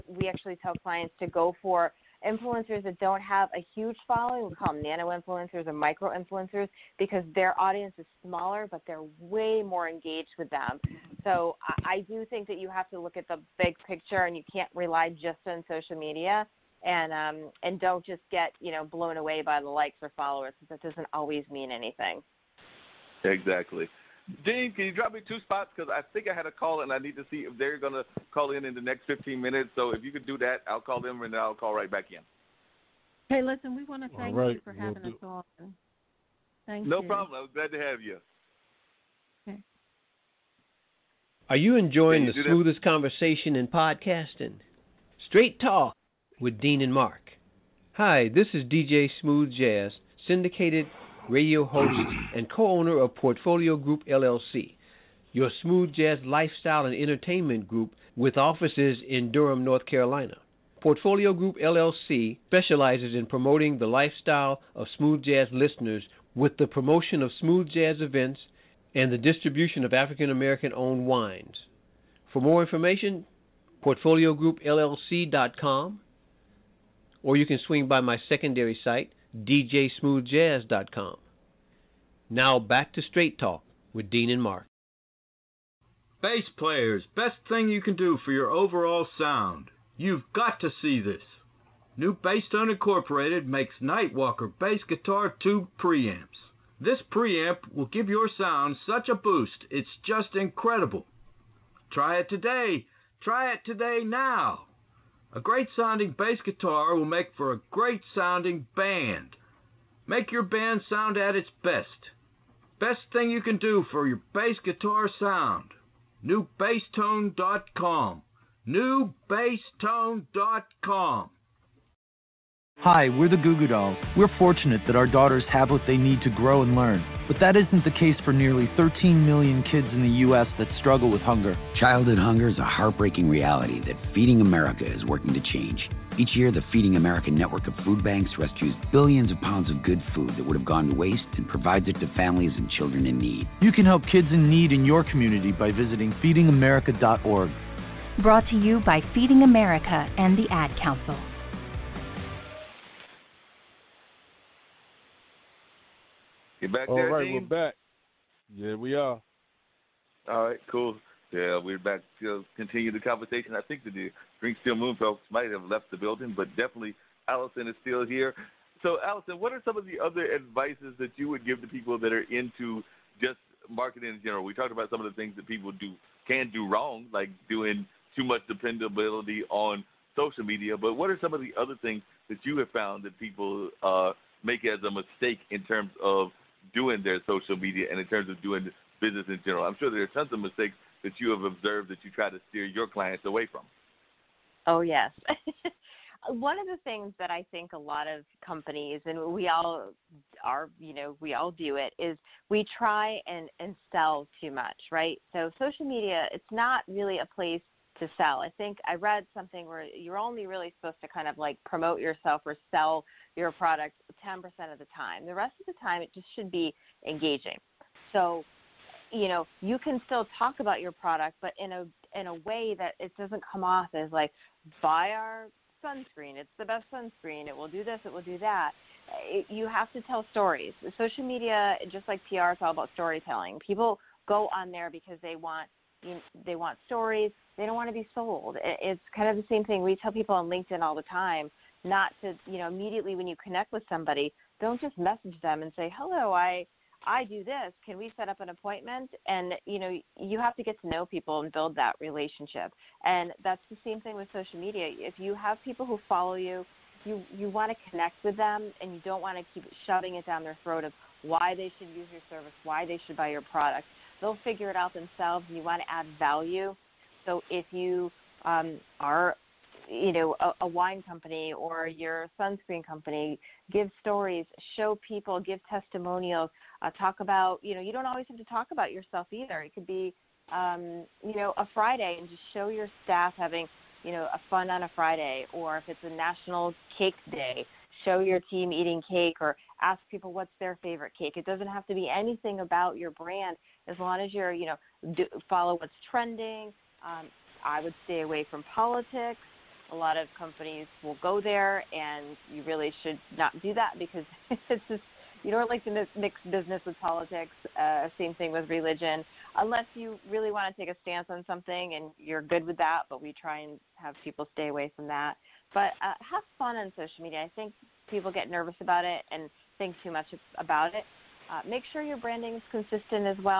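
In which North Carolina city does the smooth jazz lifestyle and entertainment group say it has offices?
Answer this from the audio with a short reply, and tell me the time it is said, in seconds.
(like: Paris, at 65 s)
Durham, at 59 s.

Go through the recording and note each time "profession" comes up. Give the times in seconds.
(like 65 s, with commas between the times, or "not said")
not said.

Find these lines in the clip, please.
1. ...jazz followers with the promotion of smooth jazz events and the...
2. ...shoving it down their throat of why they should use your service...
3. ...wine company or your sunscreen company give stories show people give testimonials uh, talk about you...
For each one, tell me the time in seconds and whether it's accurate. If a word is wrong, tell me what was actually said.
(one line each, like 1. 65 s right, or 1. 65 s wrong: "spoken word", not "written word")
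1. 65 s wrong: "listeners", not "followers"
2. 259 s right
3. 270 s right.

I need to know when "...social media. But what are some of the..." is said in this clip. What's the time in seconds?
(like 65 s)
180 s.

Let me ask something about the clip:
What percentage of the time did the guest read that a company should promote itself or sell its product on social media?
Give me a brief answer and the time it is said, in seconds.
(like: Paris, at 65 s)
10%, at 214 s.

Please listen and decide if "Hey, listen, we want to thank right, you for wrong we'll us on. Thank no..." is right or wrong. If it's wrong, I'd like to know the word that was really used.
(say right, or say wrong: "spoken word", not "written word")
wrong: "having", not "wrong".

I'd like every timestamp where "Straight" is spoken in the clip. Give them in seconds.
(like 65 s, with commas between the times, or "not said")
45 s, 83 s.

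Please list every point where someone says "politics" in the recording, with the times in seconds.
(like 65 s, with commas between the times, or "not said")
298 s, 307 s.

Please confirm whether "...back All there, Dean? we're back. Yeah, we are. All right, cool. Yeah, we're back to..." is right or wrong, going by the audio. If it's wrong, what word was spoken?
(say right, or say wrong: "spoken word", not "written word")
right.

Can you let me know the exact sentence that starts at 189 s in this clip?
I'm sure there are tons of mistakes that you have observed that you try to steer your clients away from.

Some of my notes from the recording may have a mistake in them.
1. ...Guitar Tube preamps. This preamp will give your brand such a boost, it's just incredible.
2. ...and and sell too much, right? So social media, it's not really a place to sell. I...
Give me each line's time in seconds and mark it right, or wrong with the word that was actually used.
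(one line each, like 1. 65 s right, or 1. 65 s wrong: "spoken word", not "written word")
1. 94 s wrong: "sound", not "brand"
2. 203 s right.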